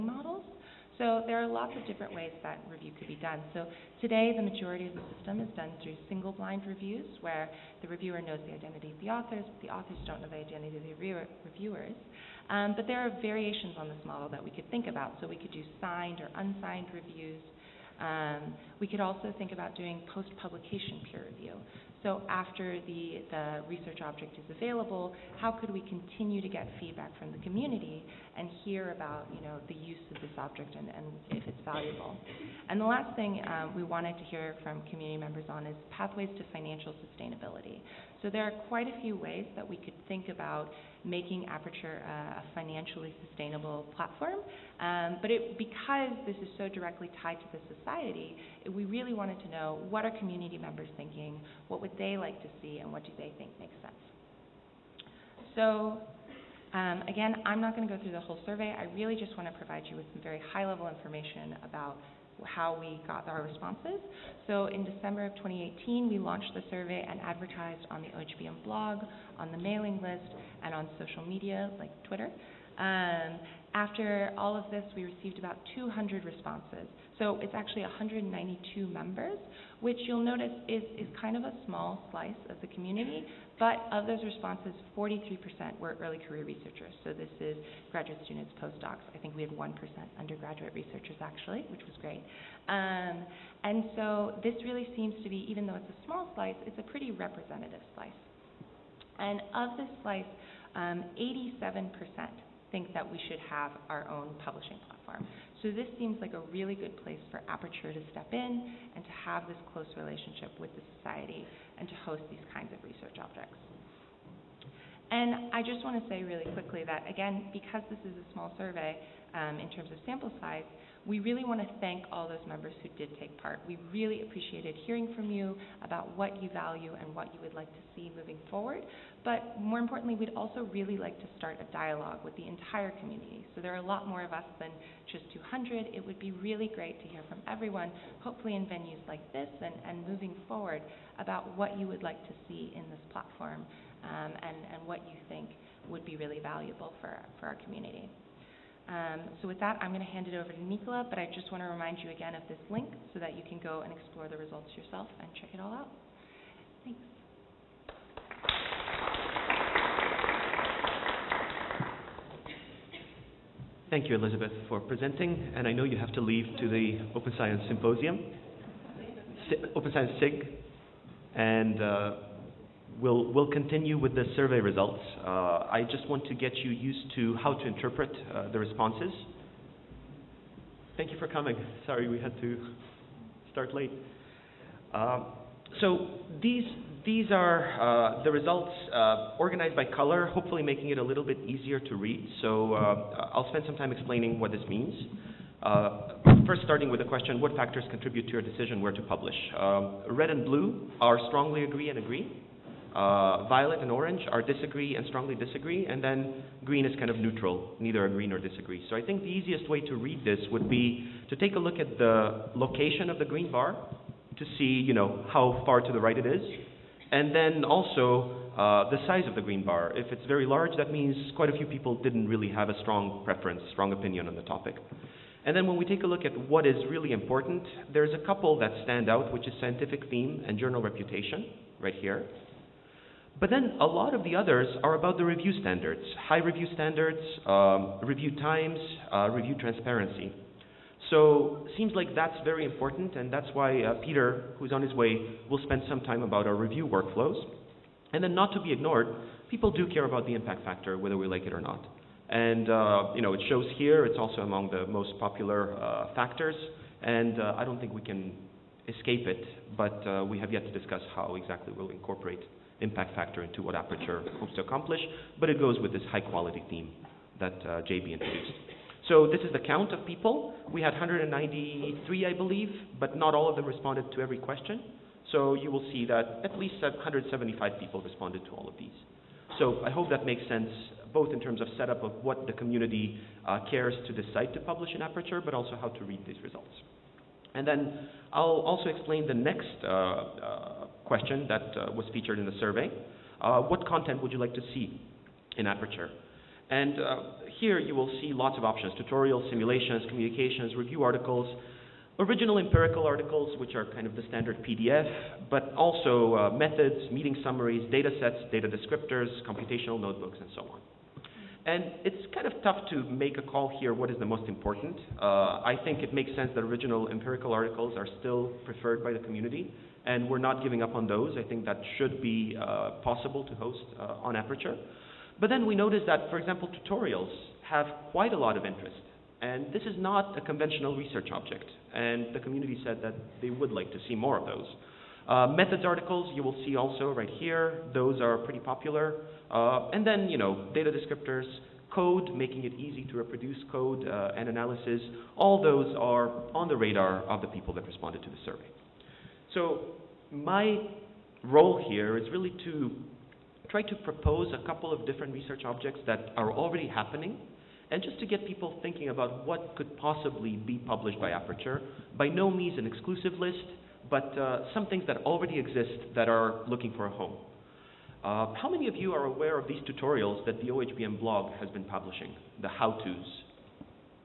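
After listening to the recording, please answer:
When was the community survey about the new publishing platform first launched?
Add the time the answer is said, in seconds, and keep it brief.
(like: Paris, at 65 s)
December 2018, at 64 s.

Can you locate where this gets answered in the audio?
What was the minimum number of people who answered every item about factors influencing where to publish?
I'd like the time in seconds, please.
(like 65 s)
276 s.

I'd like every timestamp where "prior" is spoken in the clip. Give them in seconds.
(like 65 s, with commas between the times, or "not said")
not said.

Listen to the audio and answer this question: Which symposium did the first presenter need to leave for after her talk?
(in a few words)
Open Science Symposium.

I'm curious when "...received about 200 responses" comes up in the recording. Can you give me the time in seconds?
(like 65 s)
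75 s.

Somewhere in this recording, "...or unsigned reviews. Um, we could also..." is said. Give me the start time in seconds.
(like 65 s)
16 s.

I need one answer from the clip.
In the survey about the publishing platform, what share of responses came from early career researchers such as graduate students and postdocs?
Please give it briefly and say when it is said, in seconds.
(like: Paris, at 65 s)
43%, at 84 s.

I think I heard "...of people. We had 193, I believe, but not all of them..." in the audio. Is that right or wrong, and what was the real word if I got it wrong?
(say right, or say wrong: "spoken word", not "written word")
right.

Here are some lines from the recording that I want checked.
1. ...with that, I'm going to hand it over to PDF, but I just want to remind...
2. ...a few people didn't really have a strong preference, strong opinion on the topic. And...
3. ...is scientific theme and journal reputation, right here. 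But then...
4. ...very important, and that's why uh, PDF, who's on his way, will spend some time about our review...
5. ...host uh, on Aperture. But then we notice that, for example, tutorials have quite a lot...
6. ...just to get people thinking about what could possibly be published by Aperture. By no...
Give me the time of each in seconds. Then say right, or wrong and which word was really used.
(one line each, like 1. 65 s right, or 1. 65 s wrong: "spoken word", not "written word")
1. 149 s wrong: "Nikola", not "PDF"
2. 221 s right
3. 229 s right
4. 242 s wrong: "Peter", not "PDF"
5. 323 s right
6. 358 s right.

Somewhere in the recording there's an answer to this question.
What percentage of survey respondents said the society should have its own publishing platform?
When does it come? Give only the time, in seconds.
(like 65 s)
100 s.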